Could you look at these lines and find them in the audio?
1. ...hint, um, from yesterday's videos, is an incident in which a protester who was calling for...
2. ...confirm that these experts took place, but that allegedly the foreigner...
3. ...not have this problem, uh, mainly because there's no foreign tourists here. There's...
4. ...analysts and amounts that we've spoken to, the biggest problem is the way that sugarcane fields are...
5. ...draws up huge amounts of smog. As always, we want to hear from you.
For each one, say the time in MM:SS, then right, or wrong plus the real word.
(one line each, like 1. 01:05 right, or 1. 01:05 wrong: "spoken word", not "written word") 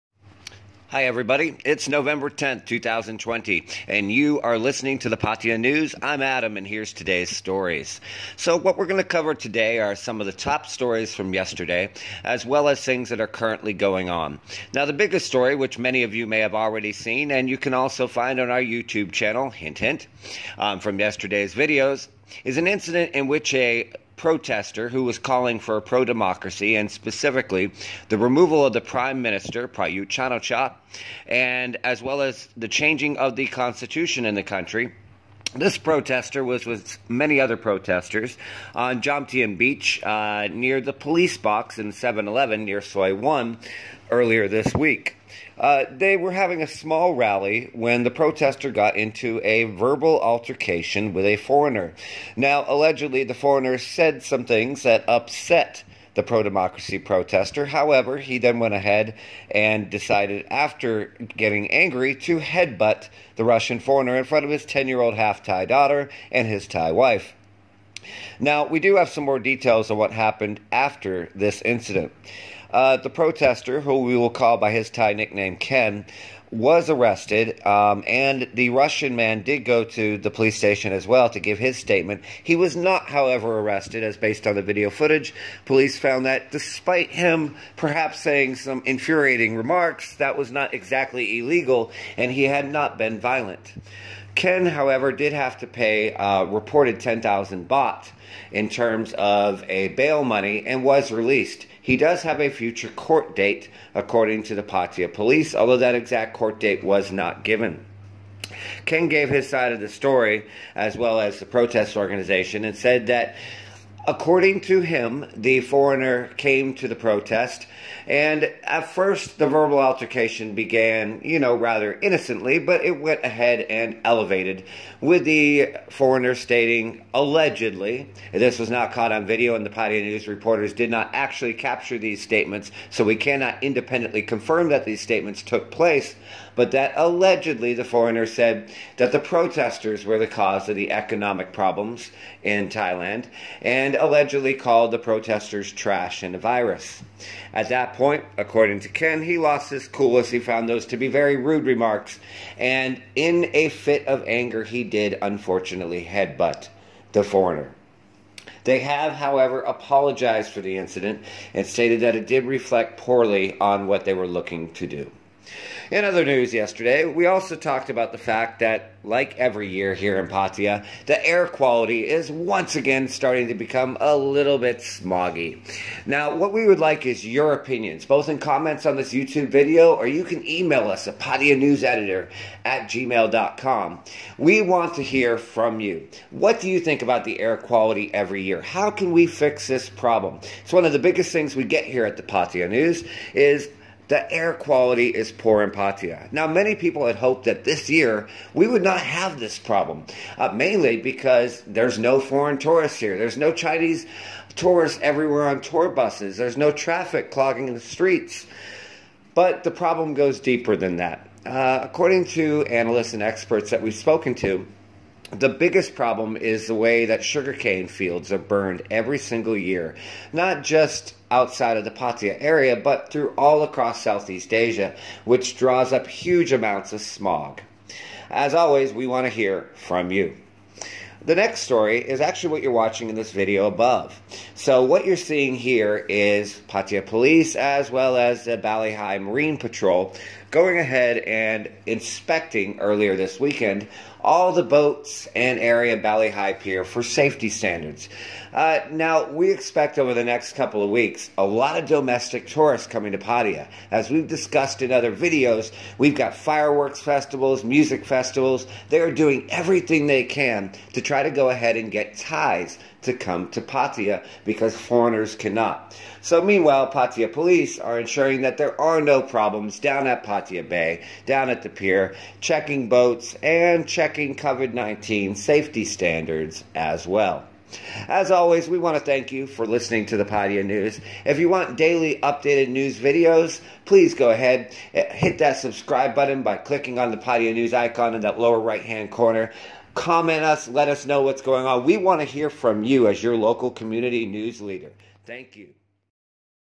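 1. 00:19 right
2. 02:14 wrong: "statements", not "experts"
3. 03:18 right
4. 03:32 wrong: "experts", not "amounts"
5. 03:45 right.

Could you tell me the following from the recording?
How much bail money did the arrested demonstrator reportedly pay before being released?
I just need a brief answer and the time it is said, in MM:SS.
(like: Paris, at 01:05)
10,000 baht, at 01:36.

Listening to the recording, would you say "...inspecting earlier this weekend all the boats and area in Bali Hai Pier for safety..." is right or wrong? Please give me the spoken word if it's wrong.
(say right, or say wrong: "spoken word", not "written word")
right.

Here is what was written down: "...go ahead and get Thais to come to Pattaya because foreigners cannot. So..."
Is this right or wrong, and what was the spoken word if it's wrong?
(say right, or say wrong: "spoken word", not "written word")
right.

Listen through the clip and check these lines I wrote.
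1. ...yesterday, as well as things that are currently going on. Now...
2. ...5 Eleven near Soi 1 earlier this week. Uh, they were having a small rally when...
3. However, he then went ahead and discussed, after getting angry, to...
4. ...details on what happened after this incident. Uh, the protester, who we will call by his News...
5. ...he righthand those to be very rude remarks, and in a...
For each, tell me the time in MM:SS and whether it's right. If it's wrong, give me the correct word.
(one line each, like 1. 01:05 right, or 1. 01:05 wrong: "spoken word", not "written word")
1. 00:11 right
2. 00:41 wrong: "7", not "5"
3. 00:57 wrong: "decided", not "discussed"
4. 01:09 wrong: "Thai", not "News"
5. 02:30 wrong: "found", not "righthand".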